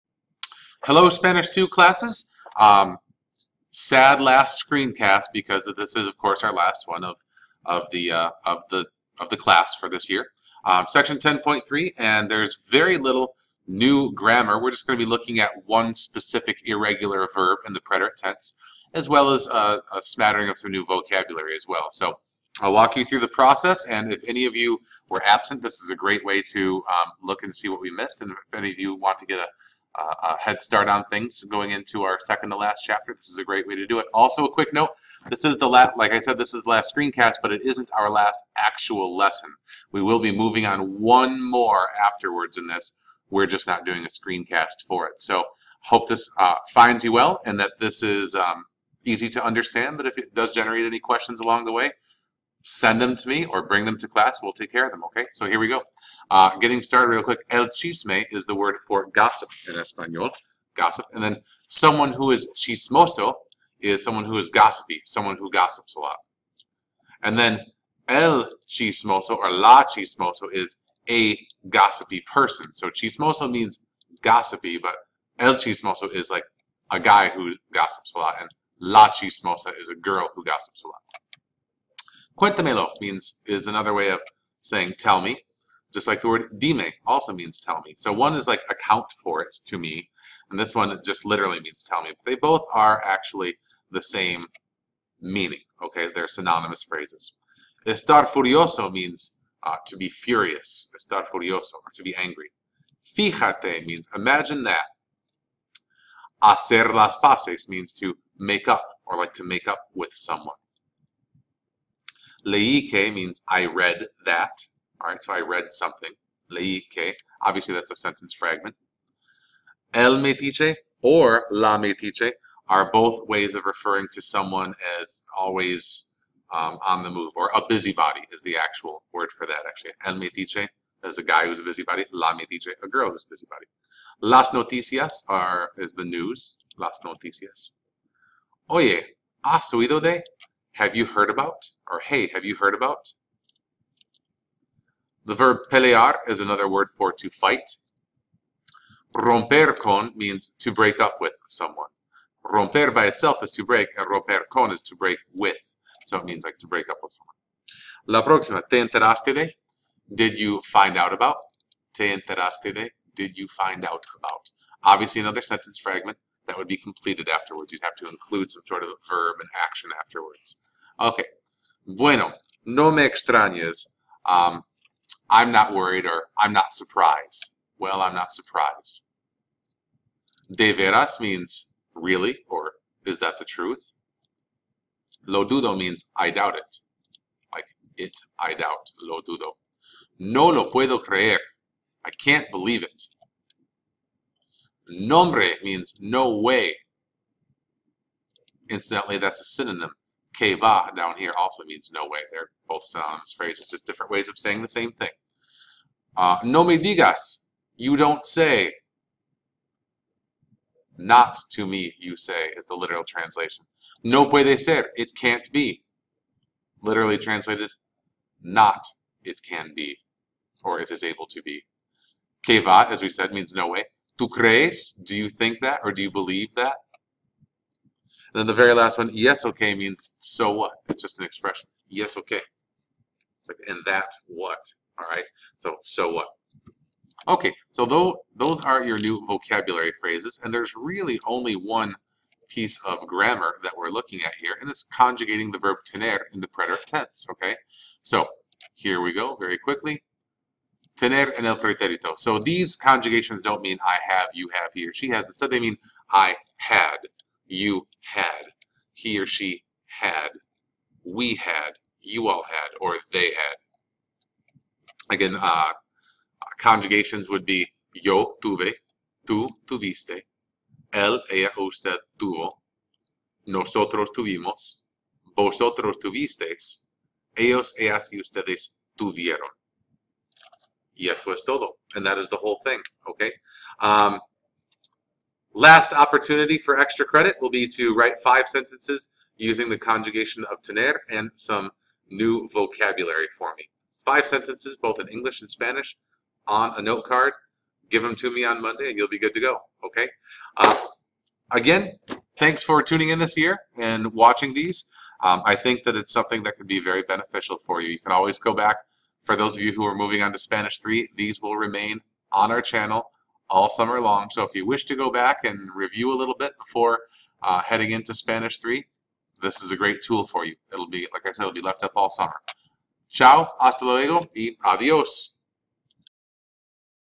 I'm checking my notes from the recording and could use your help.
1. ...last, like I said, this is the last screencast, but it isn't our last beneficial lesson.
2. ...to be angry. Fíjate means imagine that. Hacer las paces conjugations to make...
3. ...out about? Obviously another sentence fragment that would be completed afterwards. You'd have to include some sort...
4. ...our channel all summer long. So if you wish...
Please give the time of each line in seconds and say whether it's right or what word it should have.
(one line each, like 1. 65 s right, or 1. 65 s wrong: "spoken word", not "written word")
1. 35 s wrong: "actual", not "beneficial"
2. 101 s wrong: "means", not "conjugations"
3. 163 s right
4. 312 s right.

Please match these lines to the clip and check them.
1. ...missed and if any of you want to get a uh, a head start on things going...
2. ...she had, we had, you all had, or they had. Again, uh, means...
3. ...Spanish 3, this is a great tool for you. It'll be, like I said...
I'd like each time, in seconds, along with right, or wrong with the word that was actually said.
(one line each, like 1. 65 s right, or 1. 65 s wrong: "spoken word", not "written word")
1. 27 s right
2. 259 s wrong: "conjugations", not "means"
3. 318 s right.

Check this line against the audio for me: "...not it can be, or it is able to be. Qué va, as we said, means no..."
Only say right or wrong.
right.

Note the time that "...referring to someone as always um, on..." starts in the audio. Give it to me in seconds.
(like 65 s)
123 s.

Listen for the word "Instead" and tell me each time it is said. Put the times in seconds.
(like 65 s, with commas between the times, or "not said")
255 s.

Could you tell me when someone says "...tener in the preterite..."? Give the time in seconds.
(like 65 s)
245 s.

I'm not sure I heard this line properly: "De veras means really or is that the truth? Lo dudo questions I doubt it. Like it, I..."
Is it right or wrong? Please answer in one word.
wrong.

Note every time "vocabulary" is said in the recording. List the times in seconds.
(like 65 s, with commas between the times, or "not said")
20 s, 239 s, 292 s.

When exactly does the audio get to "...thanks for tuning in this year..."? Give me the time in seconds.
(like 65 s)
302 s.